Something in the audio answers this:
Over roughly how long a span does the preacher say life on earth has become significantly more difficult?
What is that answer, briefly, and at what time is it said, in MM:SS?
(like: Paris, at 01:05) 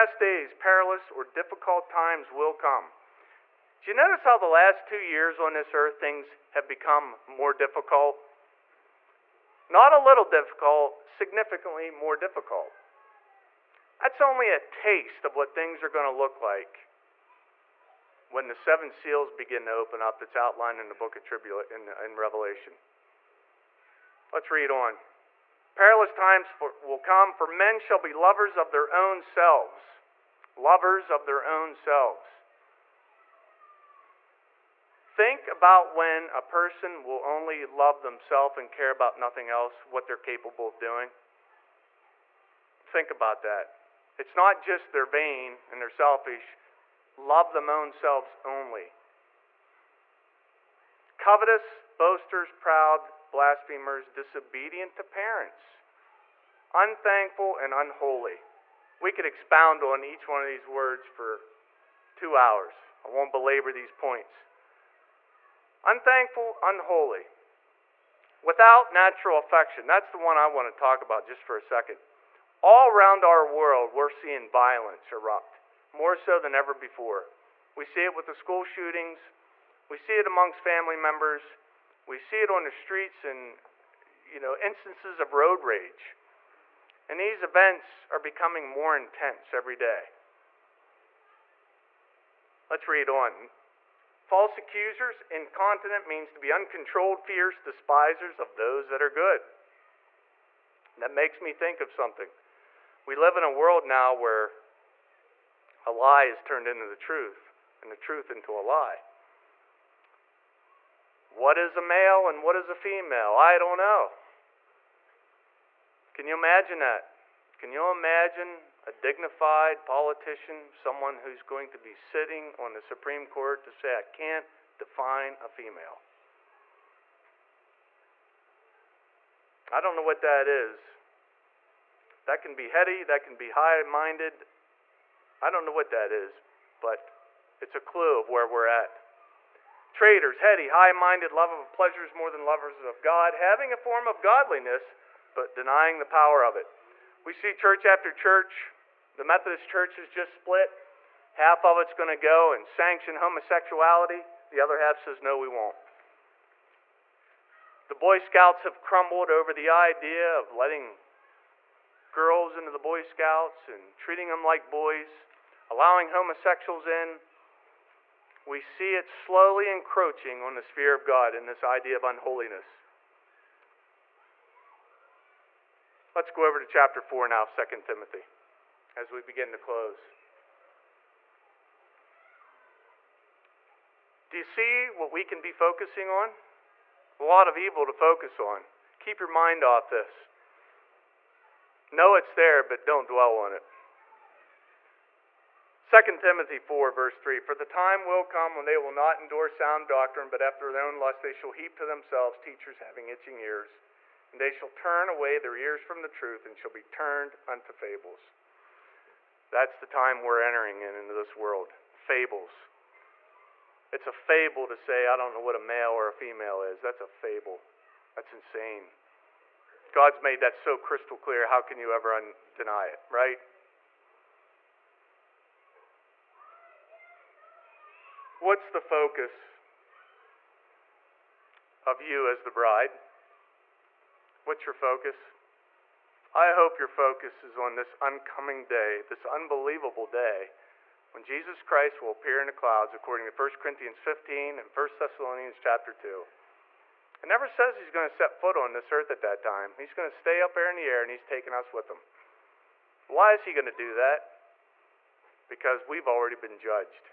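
the last two years, at 00:04.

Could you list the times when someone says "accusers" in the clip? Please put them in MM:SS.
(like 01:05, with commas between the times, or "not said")
01:34.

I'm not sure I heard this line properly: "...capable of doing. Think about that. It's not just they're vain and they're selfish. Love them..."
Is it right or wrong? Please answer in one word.
right.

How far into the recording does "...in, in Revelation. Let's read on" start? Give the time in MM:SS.
00:21.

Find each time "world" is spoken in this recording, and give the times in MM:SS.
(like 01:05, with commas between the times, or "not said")
01:13, 01:43, 03:31.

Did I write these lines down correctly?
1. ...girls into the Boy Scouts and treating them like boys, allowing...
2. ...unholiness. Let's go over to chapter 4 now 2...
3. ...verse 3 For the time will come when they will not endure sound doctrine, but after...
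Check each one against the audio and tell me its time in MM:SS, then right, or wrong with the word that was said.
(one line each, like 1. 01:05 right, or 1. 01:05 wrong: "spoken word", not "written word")
1. 02:42 right
2. 02:52 right
3. 03:16 right.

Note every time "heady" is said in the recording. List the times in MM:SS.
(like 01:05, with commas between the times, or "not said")
02:12, 02:20.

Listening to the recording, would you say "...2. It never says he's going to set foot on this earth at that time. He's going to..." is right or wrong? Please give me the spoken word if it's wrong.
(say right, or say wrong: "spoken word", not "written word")
right.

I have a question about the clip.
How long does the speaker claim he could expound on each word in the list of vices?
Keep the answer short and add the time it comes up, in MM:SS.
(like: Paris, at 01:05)
two hours, at 01:02.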